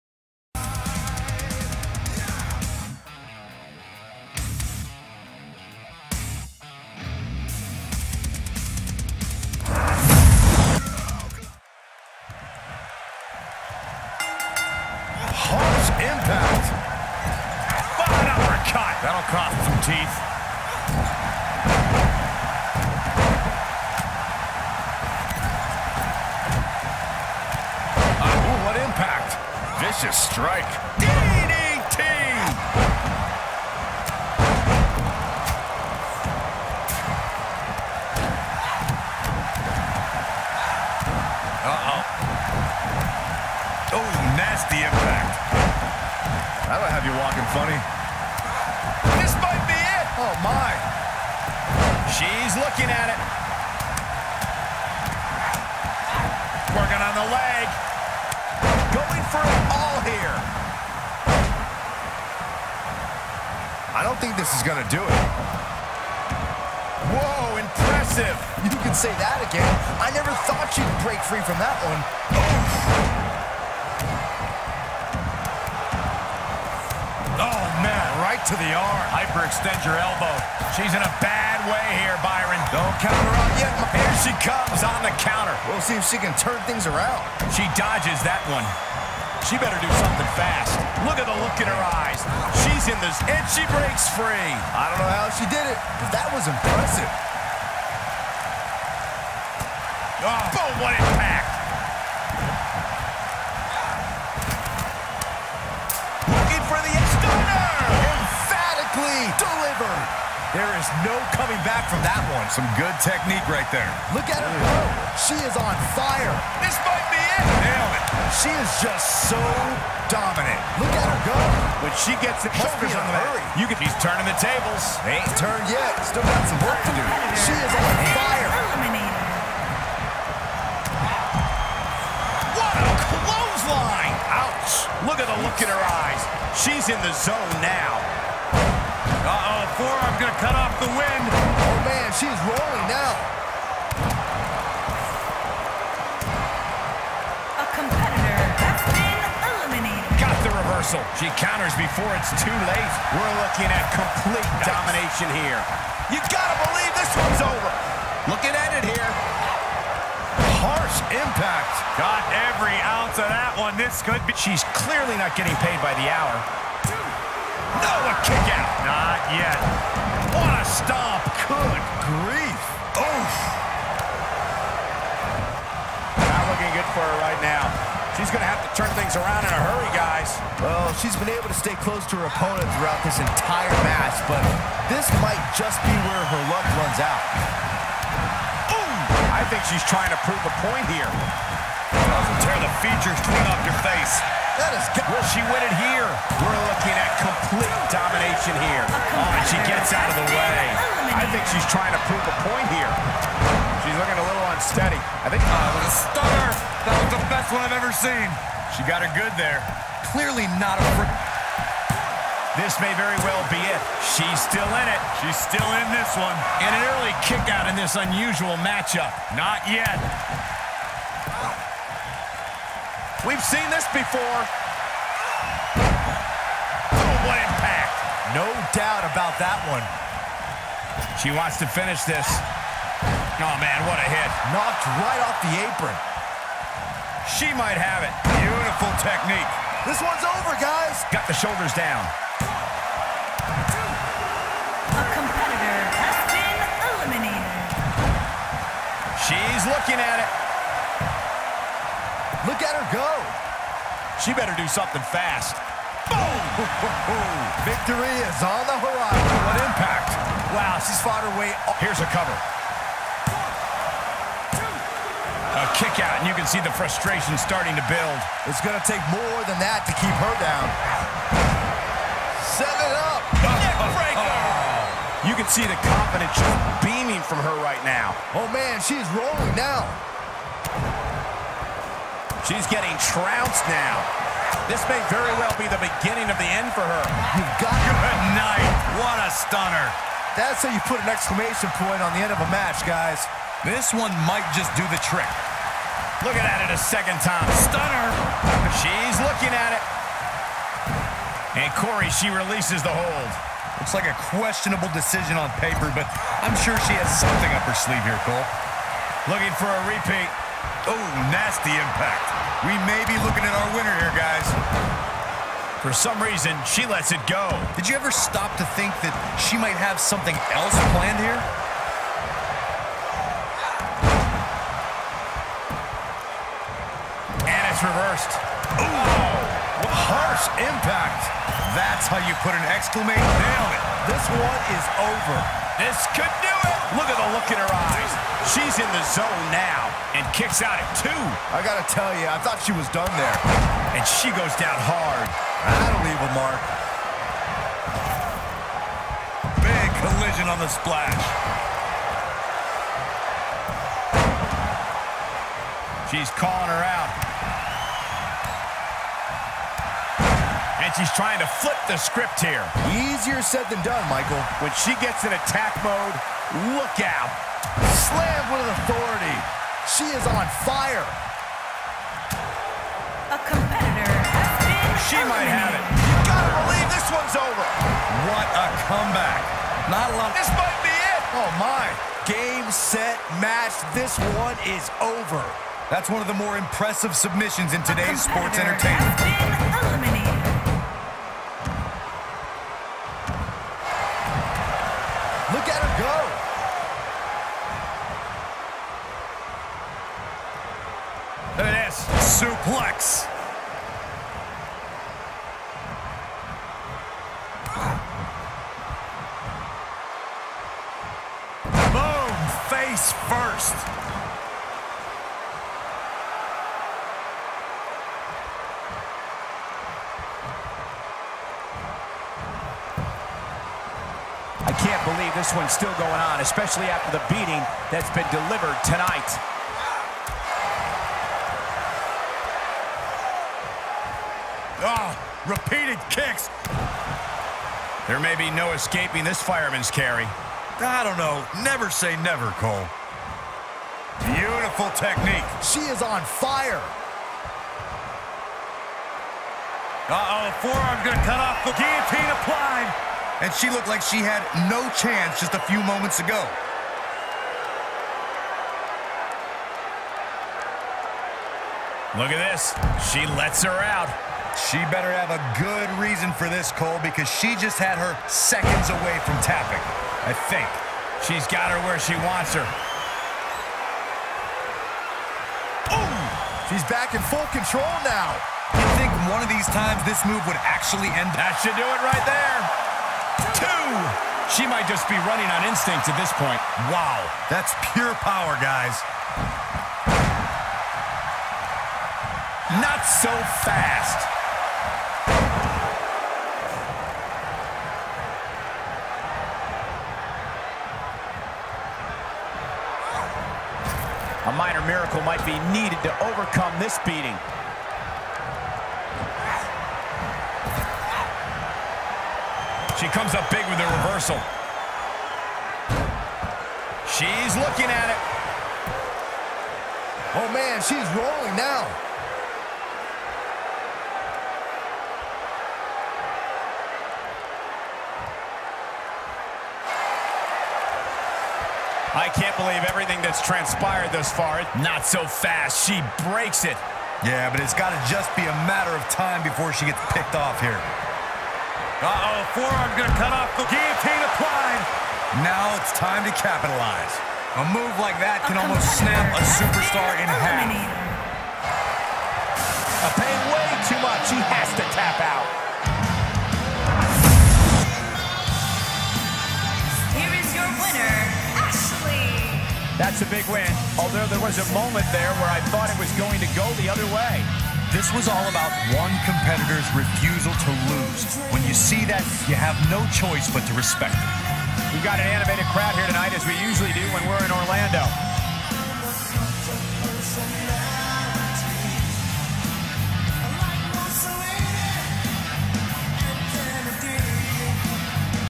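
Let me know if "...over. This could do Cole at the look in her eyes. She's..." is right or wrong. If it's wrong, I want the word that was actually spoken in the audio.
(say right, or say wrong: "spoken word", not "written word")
wrong: "Look", not "Cole".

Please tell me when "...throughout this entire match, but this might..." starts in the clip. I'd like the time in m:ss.
3:02.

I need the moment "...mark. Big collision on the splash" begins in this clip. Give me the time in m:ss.
5:46.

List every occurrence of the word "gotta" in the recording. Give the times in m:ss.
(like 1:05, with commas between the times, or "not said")
2:36, 6:16.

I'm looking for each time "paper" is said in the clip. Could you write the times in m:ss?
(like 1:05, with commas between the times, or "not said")
5:05.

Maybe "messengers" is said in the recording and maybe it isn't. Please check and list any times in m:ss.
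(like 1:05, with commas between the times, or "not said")
not said.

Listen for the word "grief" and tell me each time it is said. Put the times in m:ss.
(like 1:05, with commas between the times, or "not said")
2:52.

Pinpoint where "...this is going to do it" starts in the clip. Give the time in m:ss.
1:04.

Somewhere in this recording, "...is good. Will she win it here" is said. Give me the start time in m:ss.
3:14.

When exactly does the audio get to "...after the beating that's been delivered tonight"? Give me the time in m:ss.
7:06.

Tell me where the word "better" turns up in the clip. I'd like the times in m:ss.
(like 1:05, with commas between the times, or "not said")
1:29, 4:14, 7:44.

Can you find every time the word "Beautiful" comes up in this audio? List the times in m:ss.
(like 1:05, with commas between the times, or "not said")
3:58, 7:24.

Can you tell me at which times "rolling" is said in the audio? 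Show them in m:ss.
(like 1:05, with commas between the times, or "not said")
2:22, 4:39, 8:41.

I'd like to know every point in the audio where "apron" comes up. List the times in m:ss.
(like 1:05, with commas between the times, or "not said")
3:55.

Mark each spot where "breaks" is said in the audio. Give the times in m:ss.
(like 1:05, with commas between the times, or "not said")
1:11, 1:33, 8:56.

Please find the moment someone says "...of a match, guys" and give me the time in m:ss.
4:52.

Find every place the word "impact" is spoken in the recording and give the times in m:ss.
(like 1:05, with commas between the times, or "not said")
0:28, 0:44, 1:40, 2:41, 3:47, 4:19, 5:11, 5:30.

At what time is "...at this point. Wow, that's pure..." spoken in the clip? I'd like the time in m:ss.
8:06.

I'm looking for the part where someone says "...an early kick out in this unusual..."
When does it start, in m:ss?
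3:36.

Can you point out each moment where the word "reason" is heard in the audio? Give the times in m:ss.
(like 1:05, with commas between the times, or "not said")
5:16, 7:45.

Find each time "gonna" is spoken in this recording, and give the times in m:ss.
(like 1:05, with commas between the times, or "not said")
7:31.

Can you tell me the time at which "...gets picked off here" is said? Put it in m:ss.
8:59.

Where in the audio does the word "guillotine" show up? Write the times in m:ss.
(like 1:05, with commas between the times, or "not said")
7:31, 9:03.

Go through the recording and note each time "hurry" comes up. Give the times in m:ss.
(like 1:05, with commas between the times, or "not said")
2:02, 2:59.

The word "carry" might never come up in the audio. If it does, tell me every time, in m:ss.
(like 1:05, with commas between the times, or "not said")
7:19.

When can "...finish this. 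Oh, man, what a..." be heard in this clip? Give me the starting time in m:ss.
3:51.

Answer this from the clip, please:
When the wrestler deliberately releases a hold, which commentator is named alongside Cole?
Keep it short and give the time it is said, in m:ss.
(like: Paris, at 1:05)
Corey, at 5:01.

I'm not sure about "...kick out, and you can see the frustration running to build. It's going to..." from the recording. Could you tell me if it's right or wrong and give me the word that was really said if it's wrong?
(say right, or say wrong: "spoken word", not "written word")
wrong: "starting", not "running".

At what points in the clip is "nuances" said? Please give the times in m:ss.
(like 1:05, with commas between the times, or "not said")
not said.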